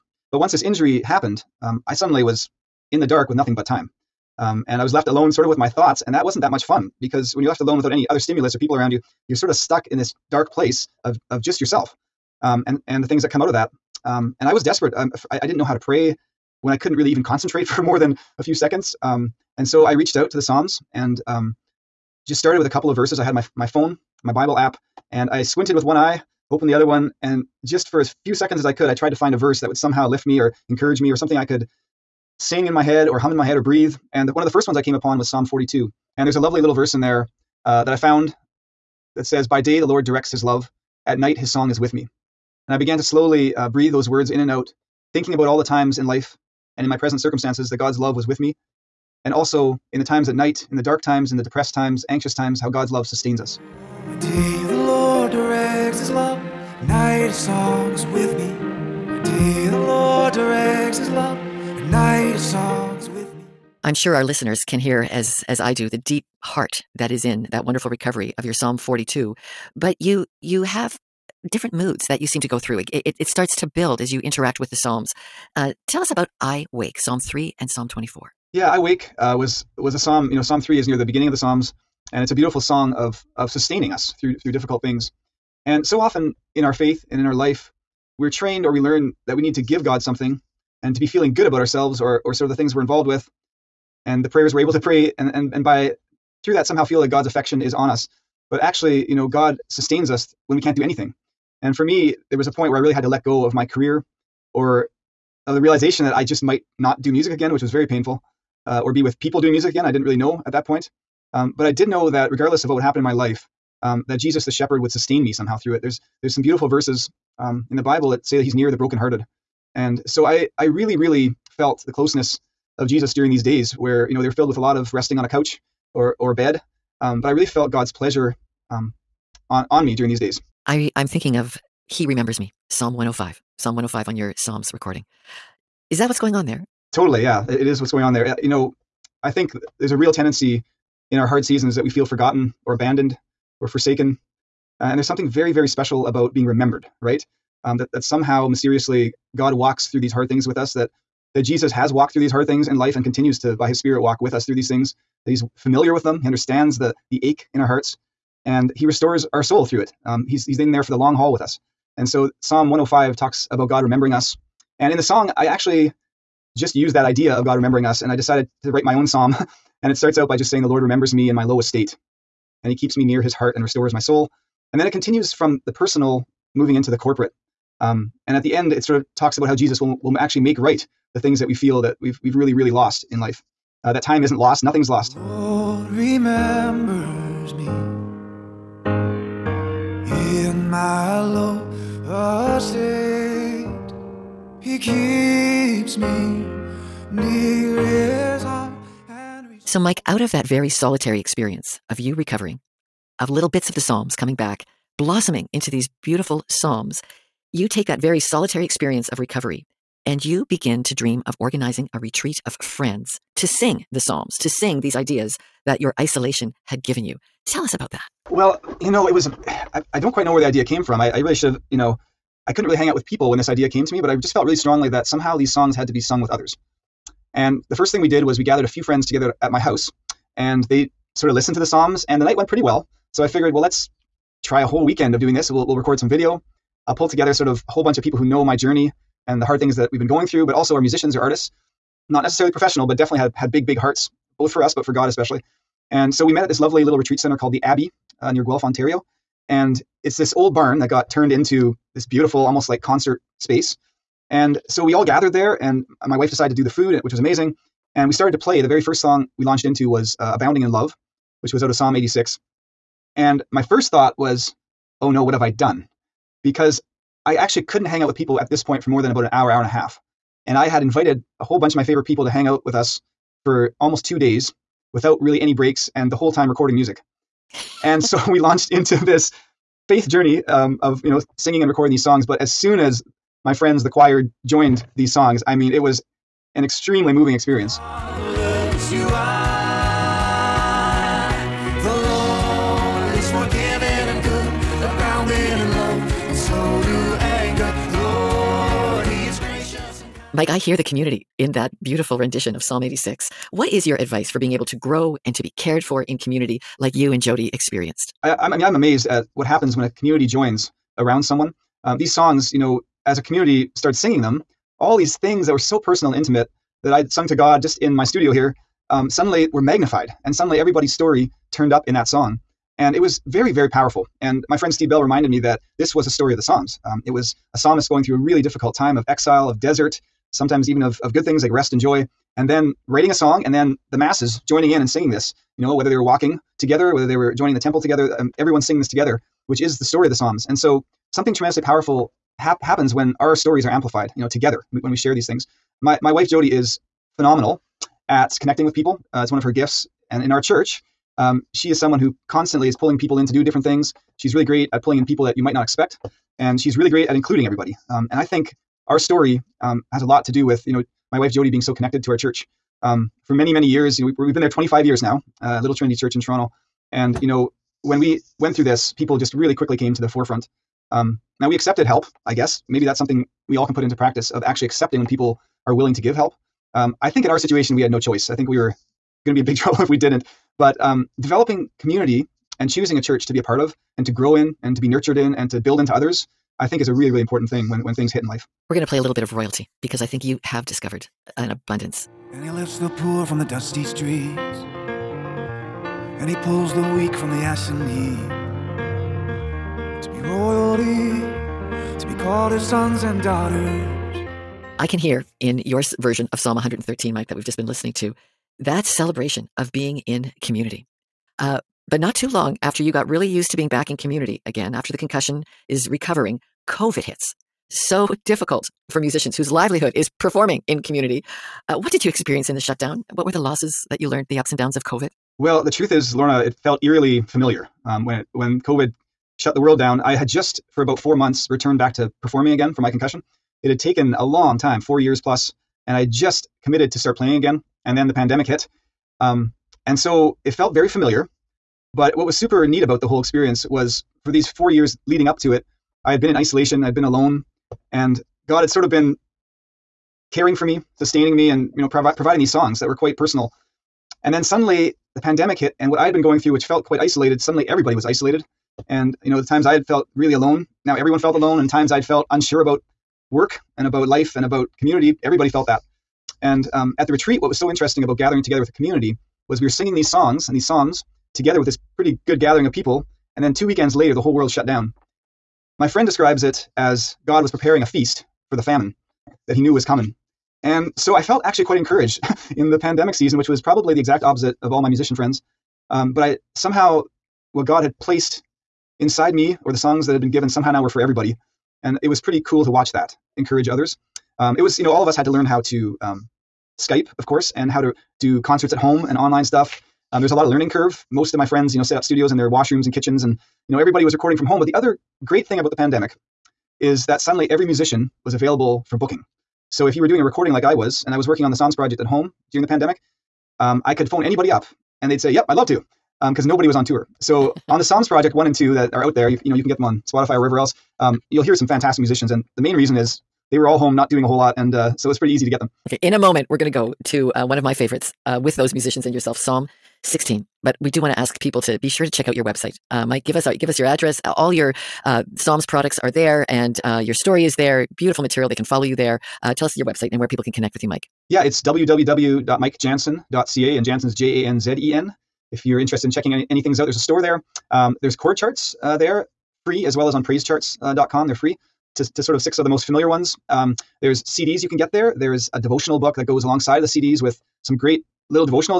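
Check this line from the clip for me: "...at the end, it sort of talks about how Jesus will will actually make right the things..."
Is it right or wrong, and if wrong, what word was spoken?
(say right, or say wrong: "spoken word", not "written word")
right.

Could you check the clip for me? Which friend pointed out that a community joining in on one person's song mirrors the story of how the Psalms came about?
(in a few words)
Steve Bell.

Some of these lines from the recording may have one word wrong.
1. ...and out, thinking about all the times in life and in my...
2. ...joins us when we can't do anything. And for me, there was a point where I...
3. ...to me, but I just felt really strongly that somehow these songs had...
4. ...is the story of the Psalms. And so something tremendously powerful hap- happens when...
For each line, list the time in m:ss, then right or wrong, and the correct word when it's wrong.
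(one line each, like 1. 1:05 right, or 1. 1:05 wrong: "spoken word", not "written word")
1. 0:44 right
2. 1:39 wrong: "sustains", not "joins"
3. 3:43 right
4. 5:39 right.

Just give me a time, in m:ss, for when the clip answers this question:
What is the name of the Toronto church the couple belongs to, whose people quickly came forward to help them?
6:05.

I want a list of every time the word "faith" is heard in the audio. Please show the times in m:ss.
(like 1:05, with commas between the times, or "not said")
1:26, 4:39.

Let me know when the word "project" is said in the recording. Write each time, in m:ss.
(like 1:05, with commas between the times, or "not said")
8:31, 8:38.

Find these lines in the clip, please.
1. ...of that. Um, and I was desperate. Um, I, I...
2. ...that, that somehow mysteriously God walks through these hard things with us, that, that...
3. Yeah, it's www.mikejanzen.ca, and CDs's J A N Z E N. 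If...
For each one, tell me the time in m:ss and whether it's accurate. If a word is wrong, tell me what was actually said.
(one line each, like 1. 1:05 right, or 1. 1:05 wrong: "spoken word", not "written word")
1. 0:13 right
2. 2:27 right
3. 9:01 wrong: "Janzen", not "CDs".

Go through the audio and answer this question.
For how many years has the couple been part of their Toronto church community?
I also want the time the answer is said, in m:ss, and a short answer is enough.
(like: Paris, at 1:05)
25, at 6:04.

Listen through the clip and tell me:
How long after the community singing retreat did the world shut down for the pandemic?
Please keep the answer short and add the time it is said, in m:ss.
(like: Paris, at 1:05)
Two weekends, at 7:53.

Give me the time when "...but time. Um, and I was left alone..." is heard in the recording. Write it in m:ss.
0:03.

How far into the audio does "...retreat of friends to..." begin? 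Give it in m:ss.
3:31.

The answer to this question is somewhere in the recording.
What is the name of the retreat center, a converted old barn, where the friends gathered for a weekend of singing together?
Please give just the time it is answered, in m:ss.
4:07.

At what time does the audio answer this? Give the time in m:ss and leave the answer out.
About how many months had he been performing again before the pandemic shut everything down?
7:10.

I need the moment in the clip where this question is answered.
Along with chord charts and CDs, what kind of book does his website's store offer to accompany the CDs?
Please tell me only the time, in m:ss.
9:15.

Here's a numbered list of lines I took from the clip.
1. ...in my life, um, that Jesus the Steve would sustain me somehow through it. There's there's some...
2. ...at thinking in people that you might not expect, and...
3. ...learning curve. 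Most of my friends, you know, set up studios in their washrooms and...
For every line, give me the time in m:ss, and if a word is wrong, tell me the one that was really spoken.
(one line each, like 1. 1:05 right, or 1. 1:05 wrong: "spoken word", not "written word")
1. 1:52 wrong: "Shepherd", not "Steve"
2. 5:54 wrong: "pulling", not "thinking"
3. 8:20 right.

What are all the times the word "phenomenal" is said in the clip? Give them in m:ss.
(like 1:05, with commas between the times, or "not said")
5:47.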